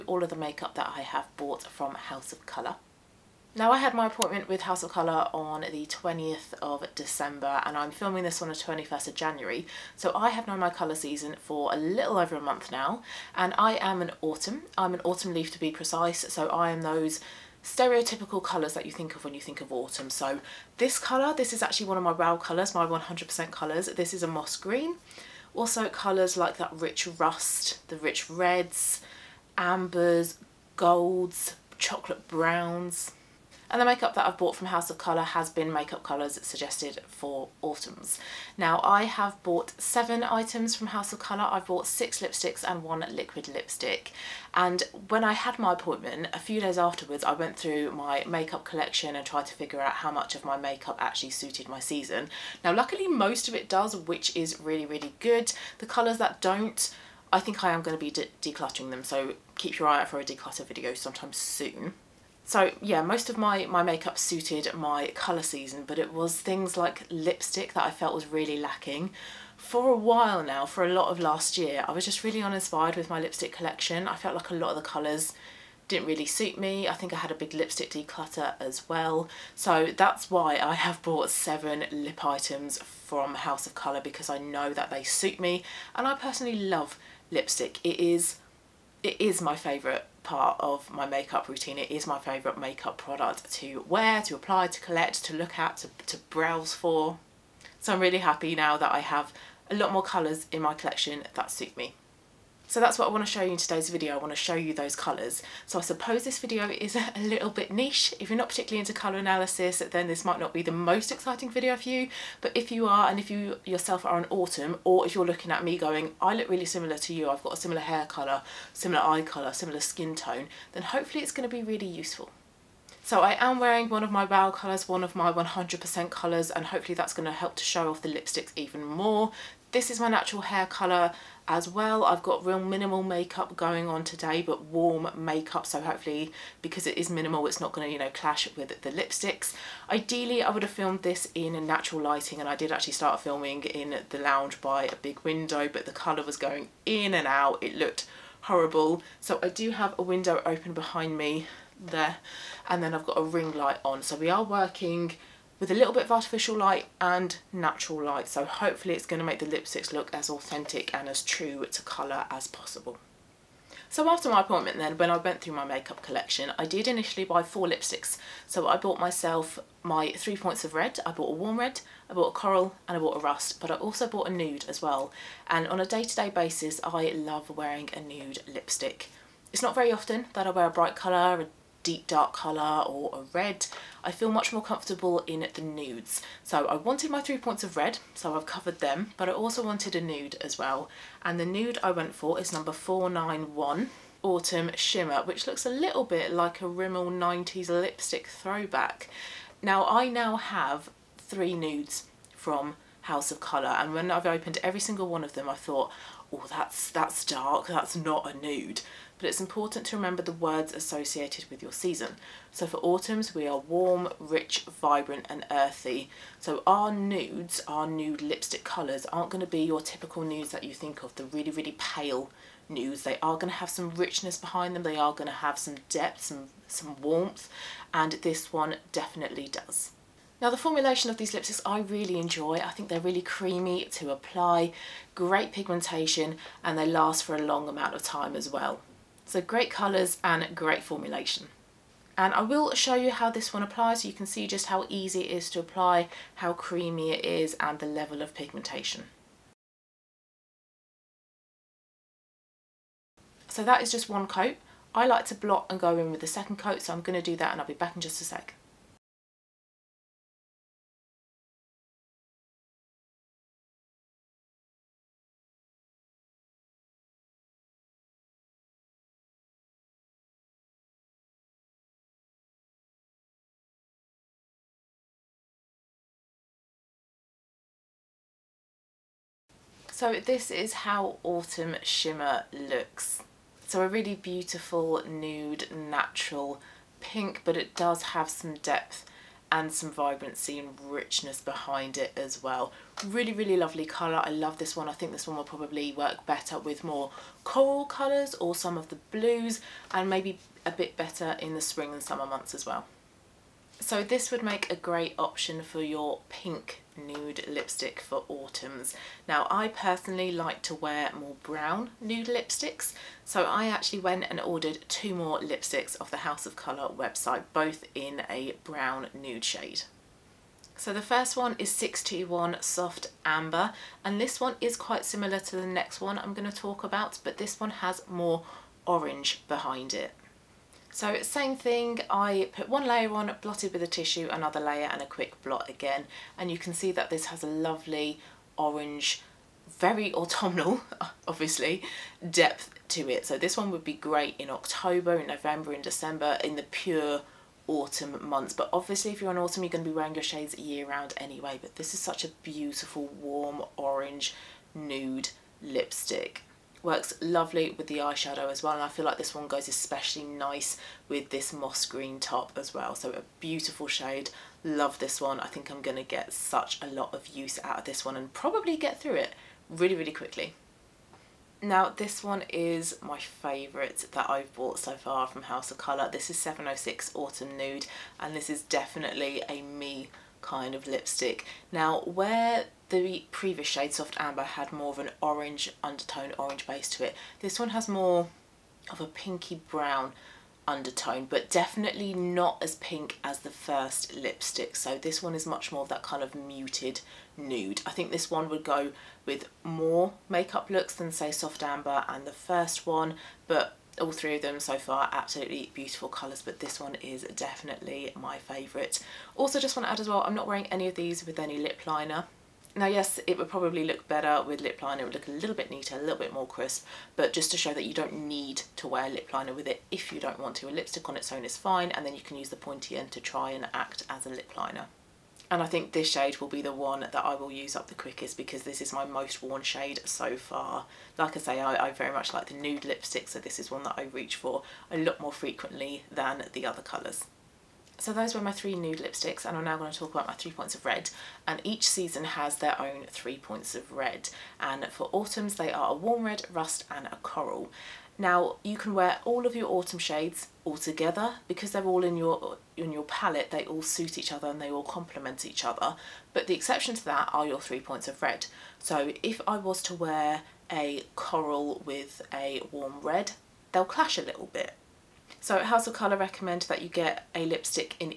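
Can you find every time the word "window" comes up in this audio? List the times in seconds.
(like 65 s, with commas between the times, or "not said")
145 s, 150 s.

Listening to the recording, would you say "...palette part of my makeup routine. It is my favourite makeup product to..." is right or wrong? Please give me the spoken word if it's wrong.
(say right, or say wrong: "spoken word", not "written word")
wrong: "favourite", not "palette".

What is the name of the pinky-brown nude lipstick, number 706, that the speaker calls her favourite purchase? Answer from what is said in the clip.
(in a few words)
Autumn Nude.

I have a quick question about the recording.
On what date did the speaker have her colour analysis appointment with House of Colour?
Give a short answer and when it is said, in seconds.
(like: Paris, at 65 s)
20th of December, at 5 s.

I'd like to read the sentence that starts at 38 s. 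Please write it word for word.
Now I have bought seven items from House of Colour.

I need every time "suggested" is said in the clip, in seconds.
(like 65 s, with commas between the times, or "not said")
36 s.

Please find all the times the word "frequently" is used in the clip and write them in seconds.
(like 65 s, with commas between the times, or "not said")
435 s.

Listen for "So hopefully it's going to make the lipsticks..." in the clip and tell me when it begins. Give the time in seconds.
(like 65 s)
158 s.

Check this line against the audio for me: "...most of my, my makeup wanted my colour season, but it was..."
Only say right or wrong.
wrong.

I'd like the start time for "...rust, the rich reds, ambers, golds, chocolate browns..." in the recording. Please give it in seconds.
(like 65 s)
27 s.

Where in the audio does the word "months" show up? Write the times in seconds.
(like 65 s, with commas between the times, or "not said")
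12 s, 302 s, 348 s.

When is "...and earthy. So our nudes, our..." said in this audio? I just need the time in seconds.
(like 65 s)
215 s.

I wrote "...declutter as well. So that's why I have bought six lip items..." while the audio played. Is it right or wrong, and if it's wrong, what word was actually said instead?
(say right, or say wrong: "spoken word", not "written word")
wrong: "seven", not "six".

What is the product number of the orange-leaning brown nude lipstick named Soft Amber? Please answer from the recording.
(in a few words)
621.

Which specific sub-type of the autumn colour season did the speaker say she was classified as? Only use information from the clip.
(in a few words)
Autumn leaf.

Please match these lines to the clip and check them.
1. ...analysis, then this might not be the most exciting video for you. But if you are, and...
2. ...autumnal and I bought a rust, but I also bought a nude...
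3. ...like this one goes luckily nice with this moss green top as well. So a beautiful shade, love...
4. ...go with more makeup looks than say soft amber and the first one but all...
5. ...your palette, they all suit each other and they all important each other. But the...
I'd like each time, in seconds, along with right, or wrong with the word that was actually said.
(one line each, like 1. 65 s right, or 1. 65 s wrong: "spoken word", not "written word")
1. 109 s right
2. 172 s wrong: "coral", not "autumnal"
3. 359 s wrong: "especially", not "luckily"
4. 398 s right
5. 452 s wrong: "complement", not "important".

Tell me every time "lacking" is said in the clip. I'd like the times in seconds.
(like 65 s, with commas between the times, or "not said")
68 s.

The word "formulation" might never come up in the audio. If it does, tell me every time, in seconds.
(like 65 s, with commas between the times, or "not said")
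230 s, 240 s.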